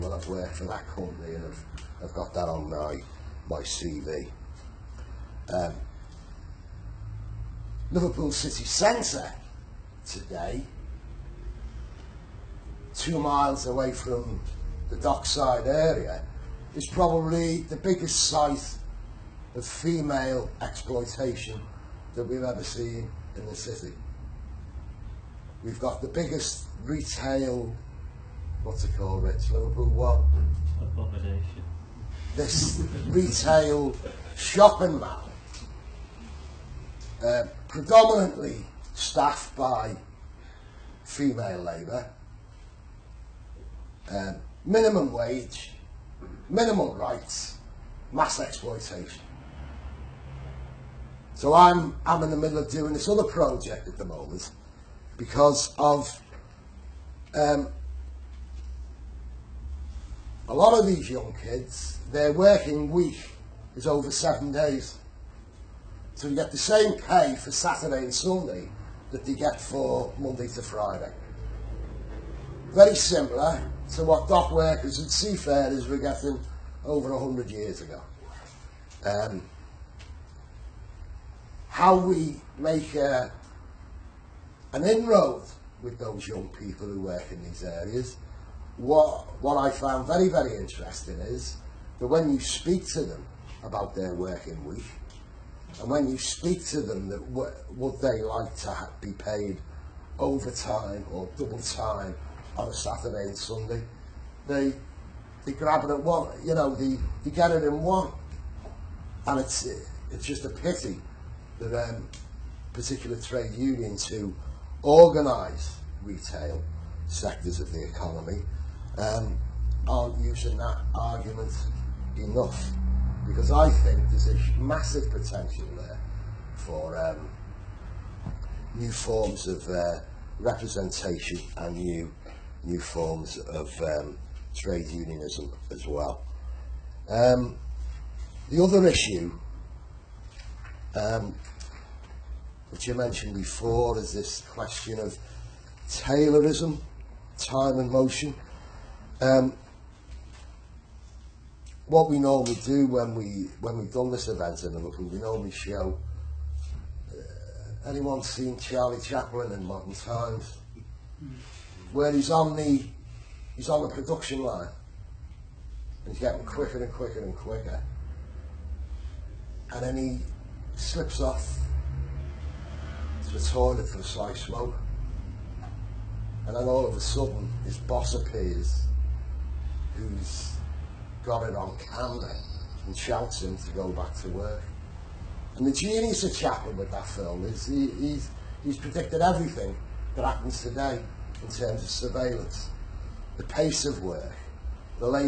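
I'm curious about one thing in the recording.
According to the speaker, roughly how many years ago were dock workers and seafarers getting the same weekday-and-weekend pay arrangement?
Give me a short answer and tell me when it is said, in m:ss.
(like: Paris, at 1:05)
Over 100 years, at 1:16.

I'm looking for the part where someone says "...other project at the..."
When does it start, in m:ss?
0:53.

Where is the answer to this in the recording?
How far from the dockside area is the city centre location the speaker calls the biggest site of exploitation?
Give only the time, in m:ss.
0:12.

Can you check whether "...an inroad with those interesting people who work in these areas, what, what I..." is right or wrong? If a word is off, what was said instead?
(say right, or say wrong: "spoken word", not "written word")
wrong: "young", not "interesting".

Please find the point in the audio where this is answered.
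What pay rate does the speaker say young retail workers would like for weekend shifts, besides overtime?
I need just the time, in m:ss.
1:41.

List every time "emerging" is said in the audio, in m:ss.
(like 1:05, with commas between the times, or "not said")
not said.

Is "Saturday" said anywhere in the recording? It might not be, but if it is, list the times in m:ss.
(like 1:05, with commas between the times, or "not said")
1:07, 1:42.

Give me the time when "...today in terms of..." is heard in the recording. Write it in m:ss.
3:10.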